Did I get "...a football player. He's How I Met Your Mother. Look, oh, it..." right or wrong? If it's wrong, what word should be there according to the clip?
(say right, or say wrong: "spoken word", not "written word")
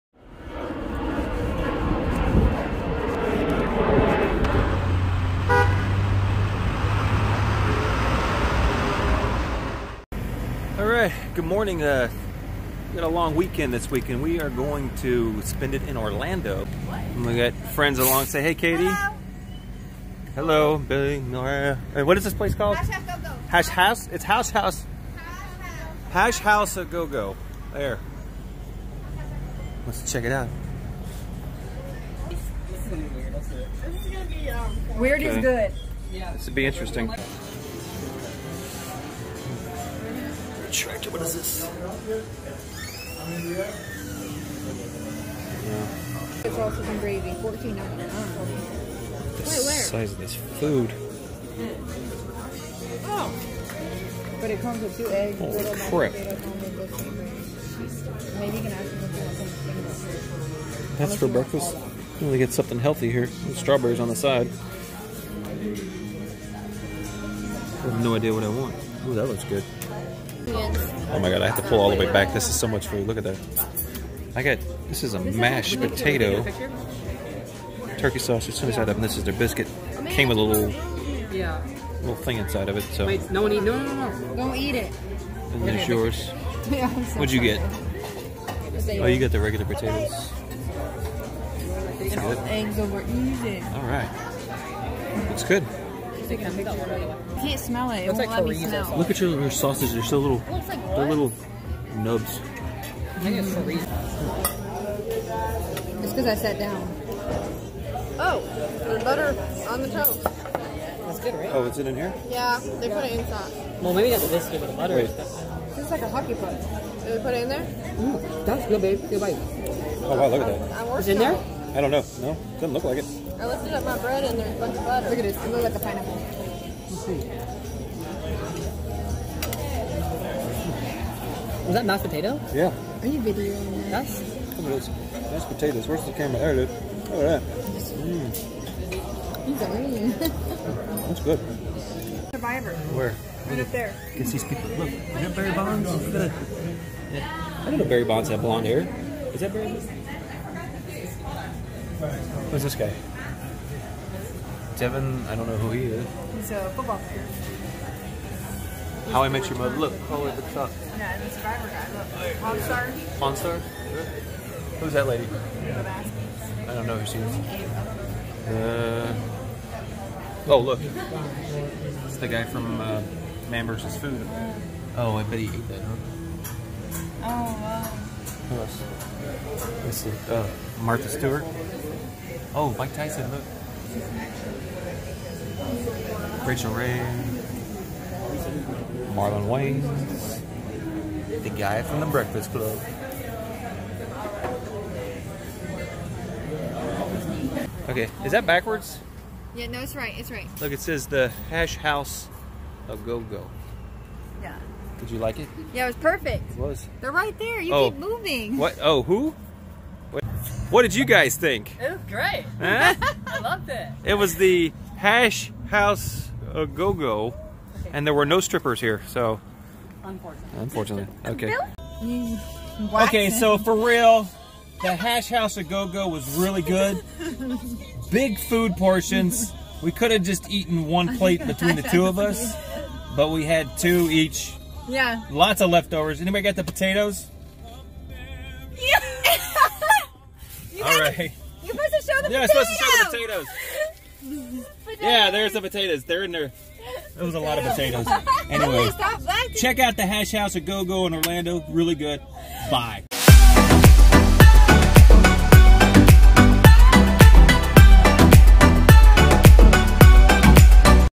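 right.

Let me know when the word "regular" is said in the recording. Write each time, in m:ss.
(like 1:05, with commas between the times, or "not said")
1:29.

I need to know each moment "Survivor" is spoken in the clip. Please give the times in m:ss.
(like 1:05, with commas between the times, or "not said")
2:22, 2:41.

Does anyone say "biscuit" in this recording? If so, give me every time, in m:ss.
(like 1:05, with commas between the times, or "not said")
1:19, 1:54.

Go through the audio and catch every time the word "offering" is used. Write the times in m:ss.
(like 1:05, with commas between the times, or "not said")
not said.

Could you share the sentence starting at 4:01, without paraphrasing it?
You're supposed to show the yeah, potatoes.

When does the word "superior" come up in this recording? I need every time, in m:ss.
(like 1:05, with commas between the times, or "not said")
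not said.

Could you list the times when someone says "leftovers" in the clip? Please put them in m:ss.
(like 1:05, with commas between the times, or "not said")
3:55.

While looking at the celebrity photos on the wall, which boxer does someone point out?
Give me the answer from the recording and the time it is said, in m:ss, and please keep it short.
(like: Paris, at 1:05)
Mike Tyson, at 3:02.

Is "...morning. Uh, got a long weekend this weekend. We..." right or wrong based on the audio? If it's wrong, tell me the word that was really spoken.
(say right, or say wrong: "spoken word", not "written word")
right.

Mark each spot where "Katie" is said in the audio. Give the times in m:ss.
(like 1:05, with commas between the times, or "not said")
0:18.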